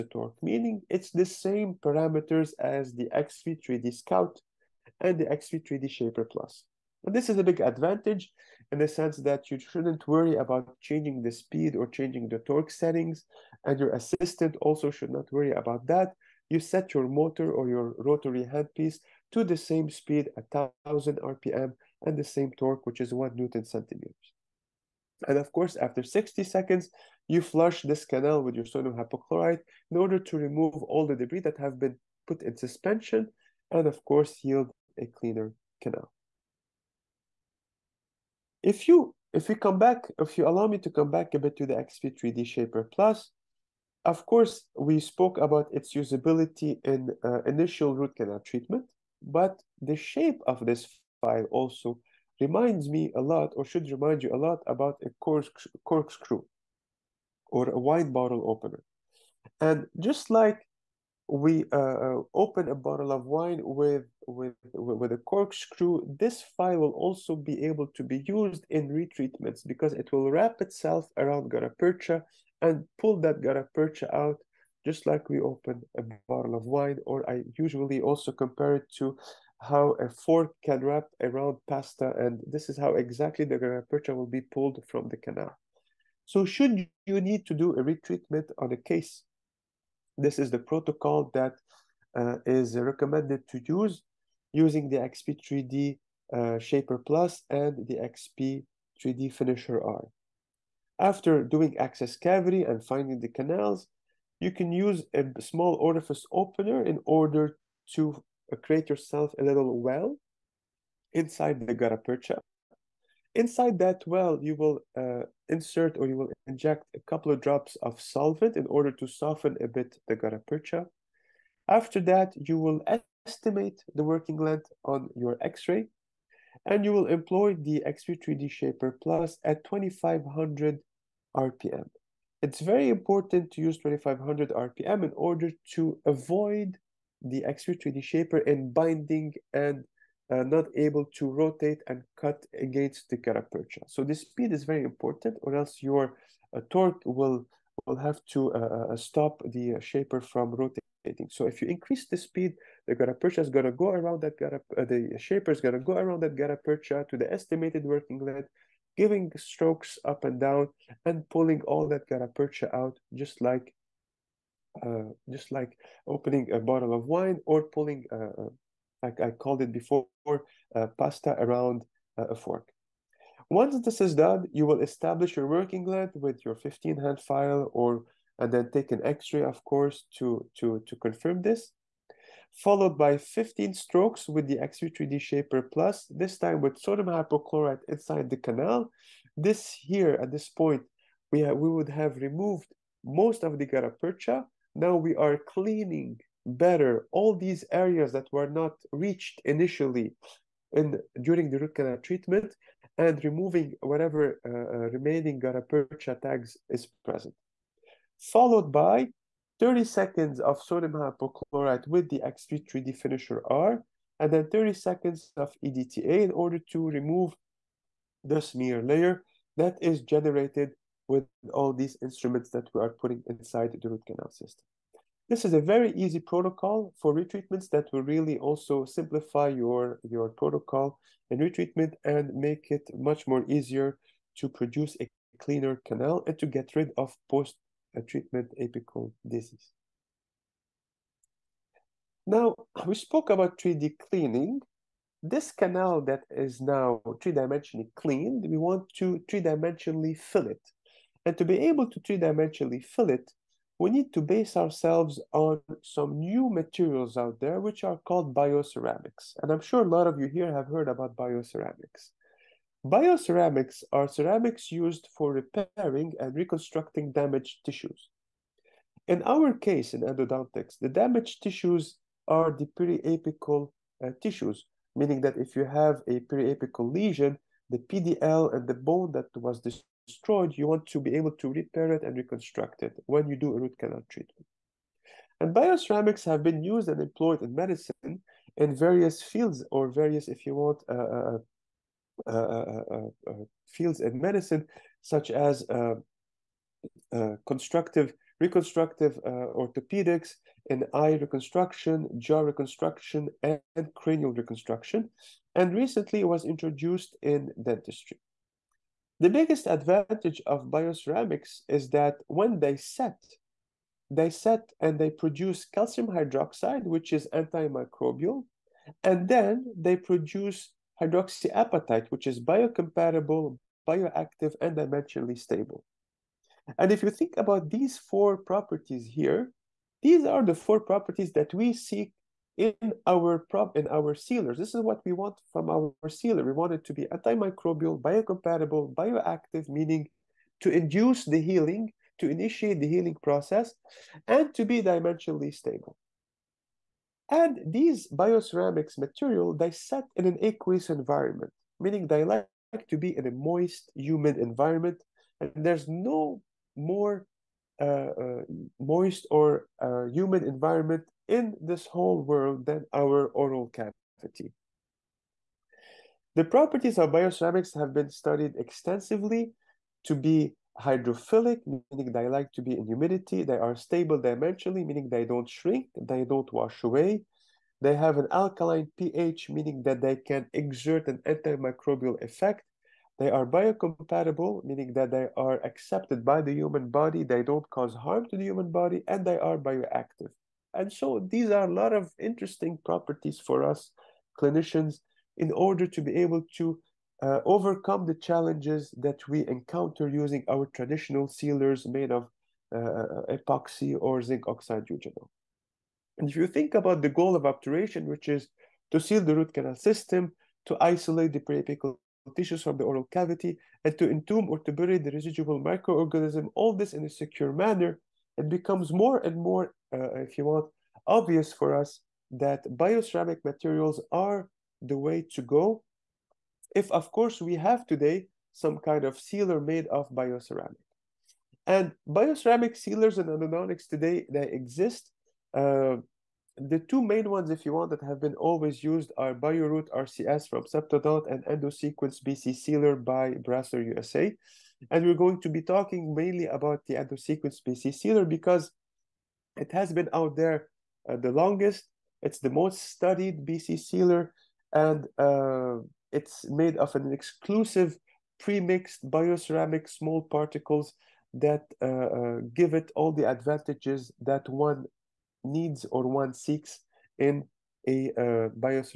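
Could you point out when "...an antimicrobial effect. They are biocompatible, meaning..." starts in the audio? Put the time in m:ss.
6:21.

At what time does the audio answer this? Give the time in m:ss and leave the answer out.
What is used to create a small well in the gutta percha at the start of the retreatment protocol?
1:45.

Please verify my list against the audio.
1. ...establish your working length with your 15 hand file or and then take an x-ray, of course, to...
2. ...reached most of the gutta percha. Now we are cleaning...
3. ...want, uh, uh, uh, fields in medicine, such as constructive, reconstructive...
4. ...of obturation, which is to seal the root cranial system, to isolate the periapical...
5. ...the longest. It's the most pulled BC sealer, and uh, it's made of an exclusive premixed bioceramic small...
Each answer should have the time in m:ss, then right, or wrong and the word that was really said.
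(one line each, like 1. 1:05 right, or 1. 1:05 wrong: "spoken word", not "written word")
1. 2:54 right
2. 3:12 wrong: "removed", not "reached"
3. 4:50 right
4. 6:47 wrong: "canal", not "cranial"
5. 7:31 wrong: "studied", not "pulled".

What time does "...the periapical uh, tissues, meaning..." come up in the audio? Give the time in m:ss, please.
4:32.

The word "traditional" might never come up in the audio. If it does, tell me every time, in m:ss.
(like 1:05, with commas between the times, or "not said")
6:40.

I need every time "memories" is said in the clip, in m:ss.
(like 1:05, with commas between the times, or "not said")
not said.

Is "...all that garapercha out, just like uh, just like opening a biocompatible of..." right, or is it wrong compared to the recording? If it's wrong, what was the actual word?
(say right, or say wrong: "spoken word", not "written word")
wrong: "bottle", not "biocompatible".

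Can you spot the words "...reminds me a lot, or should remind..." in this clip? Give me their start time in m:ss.
0:52.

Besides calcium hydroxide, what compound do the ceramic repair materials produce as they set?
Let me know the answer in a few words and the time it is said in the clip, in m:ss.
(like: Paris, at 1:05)
hydroxyapatite, at 5:21.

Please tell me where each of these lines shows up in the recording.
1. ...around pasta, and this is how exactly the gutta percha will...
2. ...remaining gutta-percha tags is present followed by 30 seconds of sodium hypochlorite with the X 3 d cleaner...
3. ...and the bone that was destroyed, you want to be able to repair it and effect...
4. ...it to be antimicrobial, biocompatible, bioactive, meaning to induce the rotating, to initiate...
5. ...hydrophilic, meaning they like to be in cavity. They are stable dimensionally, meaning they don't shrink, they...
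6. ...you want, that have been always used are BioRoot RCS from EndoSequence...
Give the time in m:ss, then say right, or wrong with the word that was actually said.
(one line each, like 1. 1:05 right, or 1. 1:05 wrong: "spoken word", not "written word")
1. 1:21 right
2. 3:24 wrong: "finisher", not "cleaner"
3. 4:38 wrong: "reconstruct", not "effect"
4. 5:36 wrong: "healing", not "rotating"
5. 6:10 wrong: "humidity", not "cavity"
6. 7:17 wrong: "Septodont", not "EndoSequence".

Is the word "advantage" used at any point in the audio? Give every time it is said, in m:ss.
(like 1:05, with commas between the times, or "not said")
0:07, 5:09, 7:43.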